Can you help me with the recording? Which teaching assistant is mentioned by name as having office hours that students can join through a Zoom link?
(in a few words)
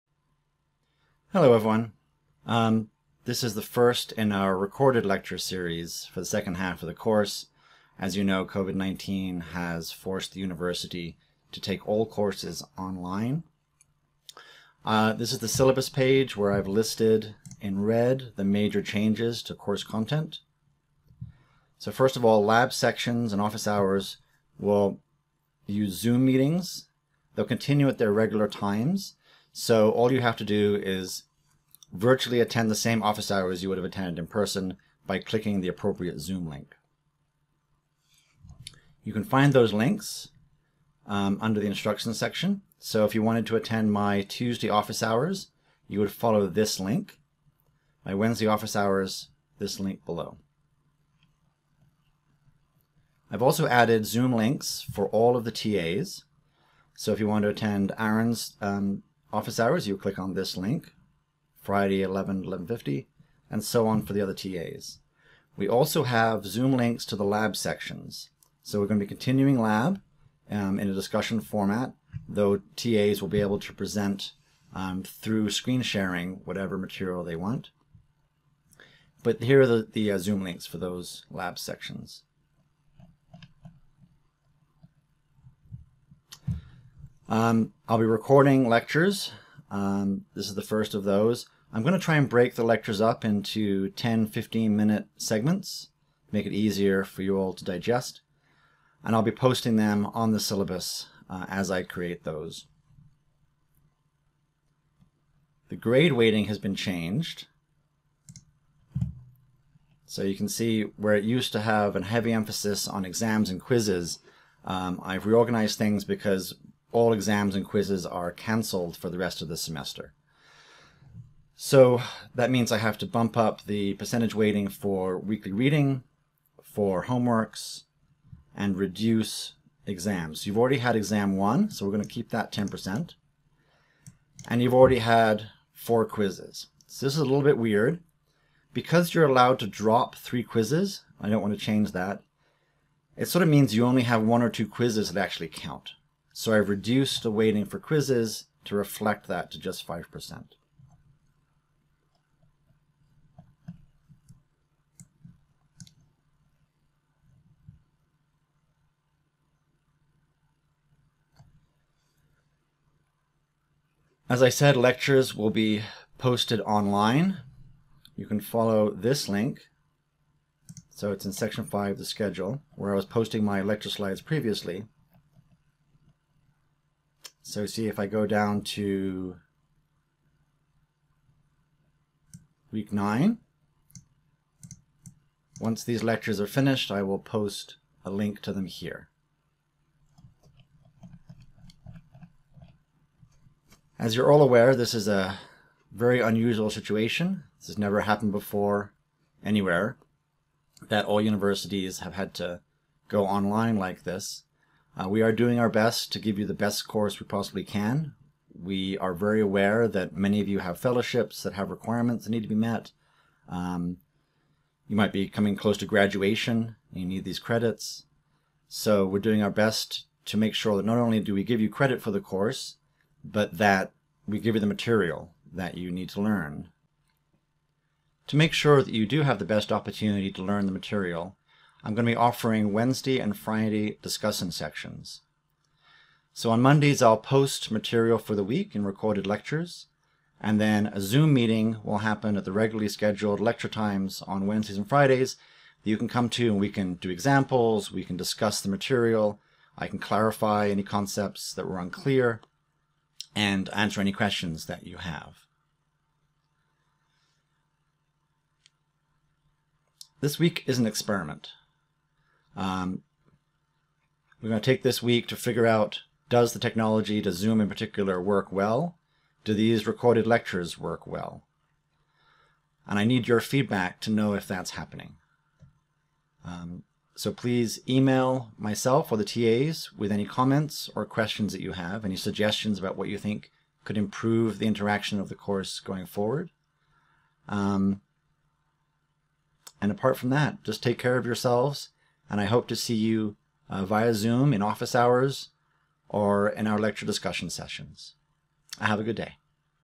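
Aaron.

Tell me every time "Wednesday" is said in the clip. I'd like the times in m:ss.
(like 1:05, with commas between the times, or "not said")
0:48, 3:52, 4:04.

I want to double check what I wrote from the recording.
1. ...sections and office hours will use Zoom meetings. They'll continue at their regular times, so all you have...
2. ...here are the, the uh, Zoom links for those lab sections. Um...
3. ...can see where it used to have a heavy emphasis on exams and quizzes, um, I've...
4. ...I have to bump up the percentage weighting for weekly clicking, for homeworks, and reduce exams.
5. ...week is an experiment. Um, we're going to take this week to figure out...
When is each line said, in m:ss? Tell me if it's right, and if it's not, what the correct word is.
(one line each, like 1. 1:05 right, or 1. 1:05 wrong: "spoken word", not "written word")
1. 0:22 right
2. 1:19 right
3. 1:50 right
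4. 2:02 wrong: "reading", not "clicking"
5. 4:20 right.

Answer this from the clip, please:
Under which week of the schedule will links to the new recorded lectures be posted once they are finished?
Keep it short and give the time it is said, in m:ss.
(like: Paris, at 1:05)
week nine, at 3:02.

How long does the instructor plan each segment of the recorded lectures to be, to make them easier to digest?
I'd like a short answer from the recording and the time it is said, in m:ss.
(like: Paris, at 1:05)
10 to 15 minutes, at 1:33.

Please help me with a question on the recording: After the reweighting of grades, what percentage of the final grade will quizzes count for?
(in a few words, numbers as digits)
5%.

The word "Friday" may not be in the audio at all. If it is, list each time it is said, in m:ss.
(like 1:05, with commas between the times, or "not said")
1:01, 3:53, 4:04.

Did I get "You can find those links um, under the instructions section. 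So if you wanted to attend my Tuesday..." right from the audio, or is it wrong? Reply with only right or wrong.
right.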